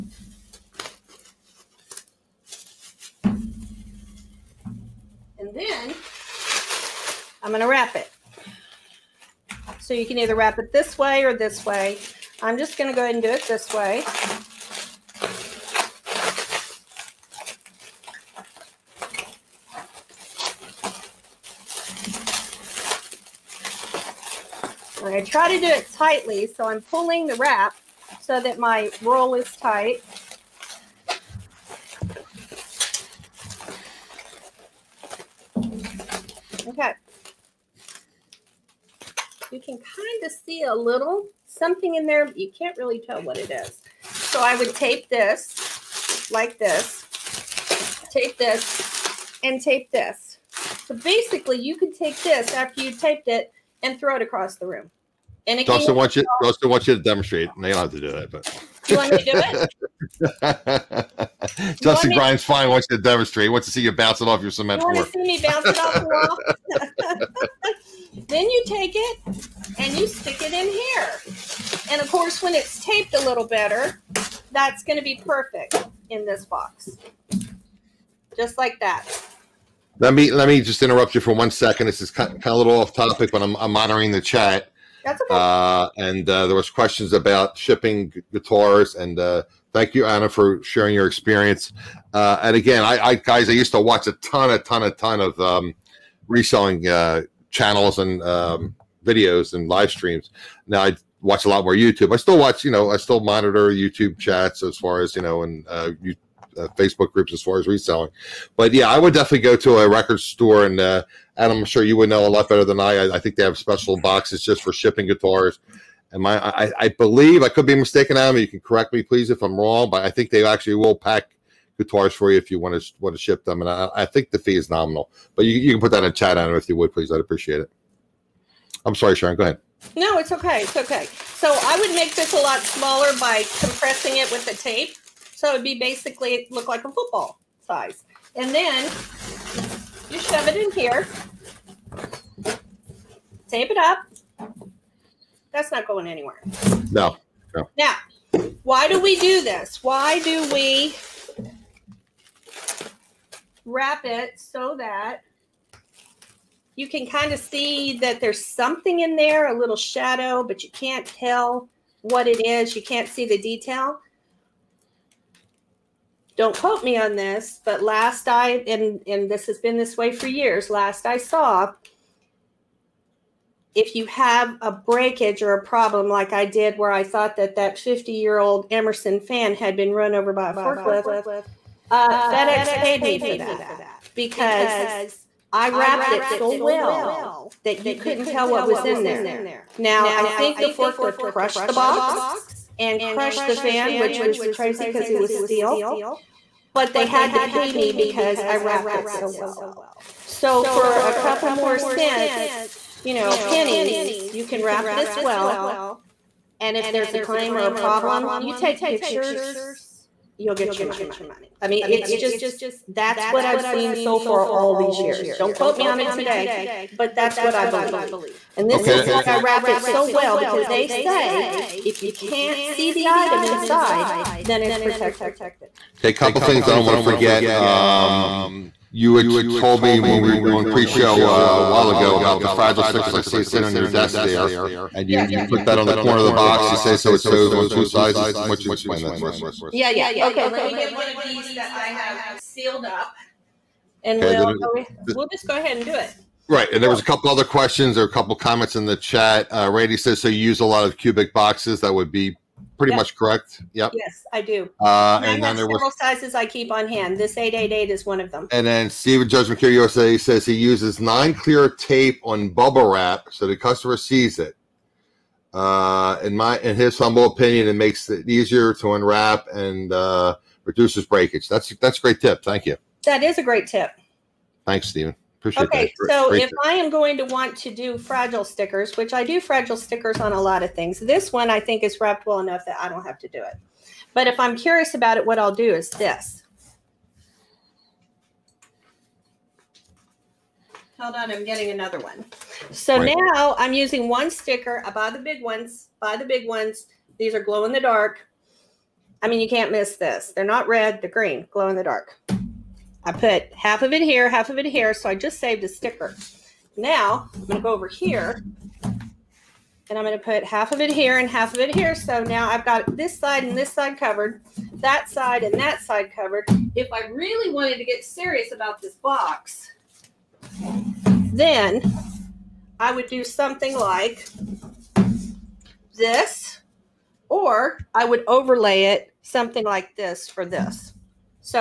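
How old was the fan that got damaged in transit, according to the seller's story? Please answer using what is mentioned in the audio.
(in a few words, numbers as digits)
50 years old.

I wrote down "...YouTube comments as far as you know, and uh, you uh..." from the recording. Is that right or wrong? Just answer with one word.
wrong.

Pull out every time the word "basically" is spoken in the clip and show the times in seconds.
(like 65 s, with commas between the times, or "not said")
50 s, 135 s.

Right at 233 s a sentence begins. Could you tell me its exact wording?
I see it sitting on your desk there, and you yeah.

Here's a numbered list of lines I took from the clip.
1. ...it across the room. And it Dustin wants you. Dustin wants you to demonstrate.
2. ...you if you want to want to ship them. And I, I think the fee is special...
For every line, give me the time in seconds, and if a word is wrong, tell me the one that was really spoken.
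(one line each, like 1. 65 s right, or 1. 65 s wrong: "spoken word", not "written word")
1. 54 s right
2. 122 s wrong: "nominal", not "special".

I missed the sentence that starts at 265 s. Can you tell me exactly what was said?
Uh, in my, in his humble opinion, it makes it easier to unwrap and uh, reduces breakage.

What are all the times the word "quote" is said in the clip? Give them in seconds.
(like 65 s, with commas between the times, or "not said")
166 s, 215 s.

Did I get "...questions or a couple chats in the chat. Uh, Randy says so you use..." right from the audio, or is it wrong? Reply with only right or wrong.
wrong.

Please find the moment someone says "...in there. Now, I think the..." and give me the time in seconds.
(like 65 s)
188 s.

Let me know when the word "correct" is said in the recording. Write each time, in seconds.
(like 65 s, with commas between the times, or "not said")
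118 s, 253 s.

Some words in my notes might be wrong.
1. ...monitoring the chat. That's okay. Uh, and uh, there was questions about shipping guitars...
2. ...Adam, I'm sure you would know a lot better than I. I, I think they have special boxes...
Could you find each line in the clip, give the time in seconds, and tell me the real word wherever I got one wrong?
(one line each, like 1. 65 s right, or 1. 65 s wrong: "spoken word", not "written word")
1. 83 s right
2. 111 s right.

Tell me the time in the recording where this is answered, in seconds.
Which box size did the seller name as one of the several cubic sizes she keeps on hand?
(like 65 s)
257 s.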